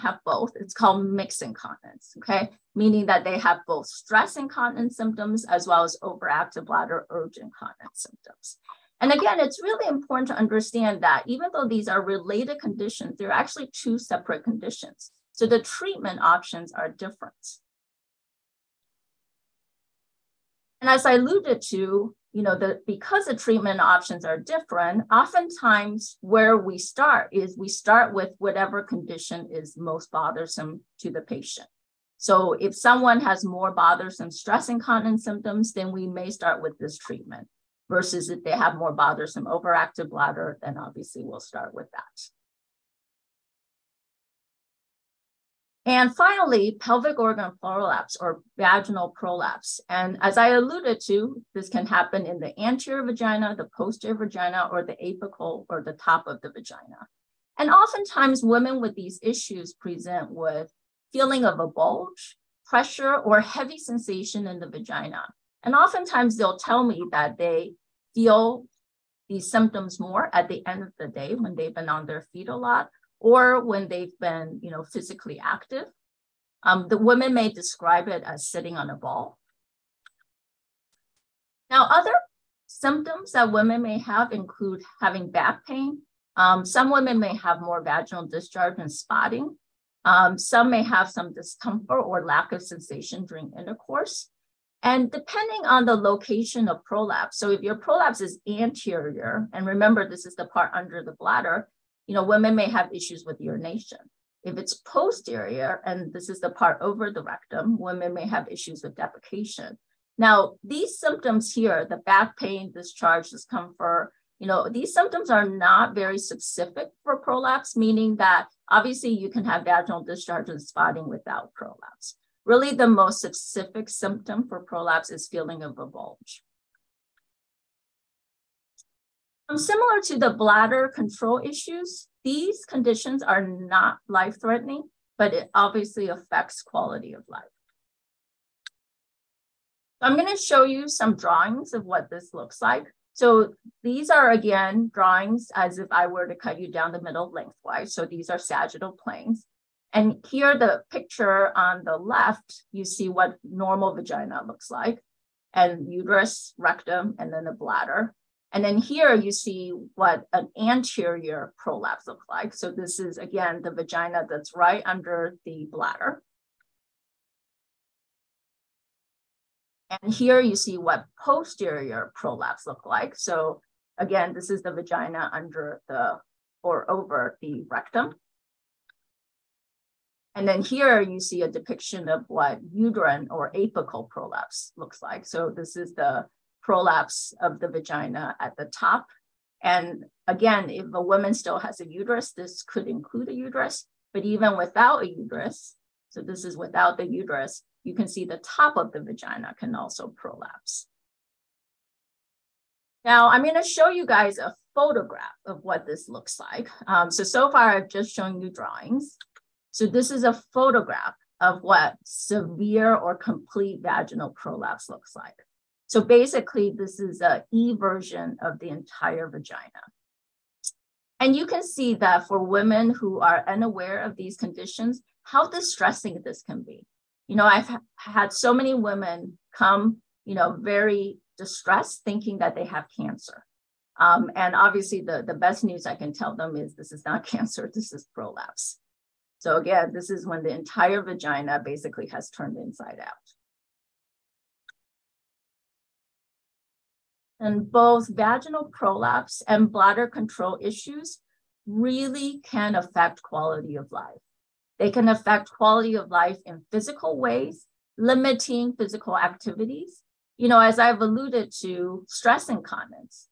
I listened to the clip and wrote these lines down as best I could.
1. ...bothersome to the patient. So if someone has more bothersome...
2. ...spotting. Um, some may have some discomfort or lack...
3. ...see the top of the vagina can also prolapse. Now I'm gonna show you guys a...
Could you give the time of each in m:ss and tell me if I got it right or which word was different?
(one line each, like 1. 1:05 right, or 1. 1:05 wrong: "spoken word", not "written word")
1. 0:30 right
2. 1:28 right
3. 3:18 right.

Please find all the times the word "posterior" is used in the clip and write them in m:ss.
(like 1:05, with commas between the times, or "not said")
0:53, 1:44, 2:51.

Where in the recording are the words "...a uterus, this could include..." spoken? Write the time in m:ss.
3:11.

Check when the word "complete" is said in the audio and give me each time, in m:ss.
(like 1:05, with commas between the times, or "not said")
3:33.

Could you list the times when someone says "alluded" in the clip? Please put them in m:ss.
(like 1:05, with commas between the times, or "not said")
0:21, 0:50, 4:21.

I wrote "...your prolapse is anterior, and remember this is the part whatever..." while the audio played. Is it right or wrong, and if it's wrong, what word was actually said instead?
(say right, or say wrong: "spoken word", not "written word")
wrong: "under", not "whatever".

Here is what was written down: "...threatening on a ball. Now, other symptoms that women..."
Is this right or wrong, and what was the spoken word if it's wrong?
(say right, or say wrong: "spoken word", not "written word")
wrong: "sitting", not "threatening".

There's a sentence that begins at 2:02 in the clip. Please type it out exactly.
Really, the most specific symptom for prolapse is feeling of a bulge.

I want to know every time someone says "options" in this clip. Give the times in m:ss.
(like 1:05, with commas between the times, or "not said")
0:16, 0:23.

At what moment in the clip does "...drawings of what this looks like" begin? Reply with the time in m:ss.
2:21.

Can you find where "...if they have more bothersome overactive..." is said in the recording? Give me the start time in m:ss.
0:38.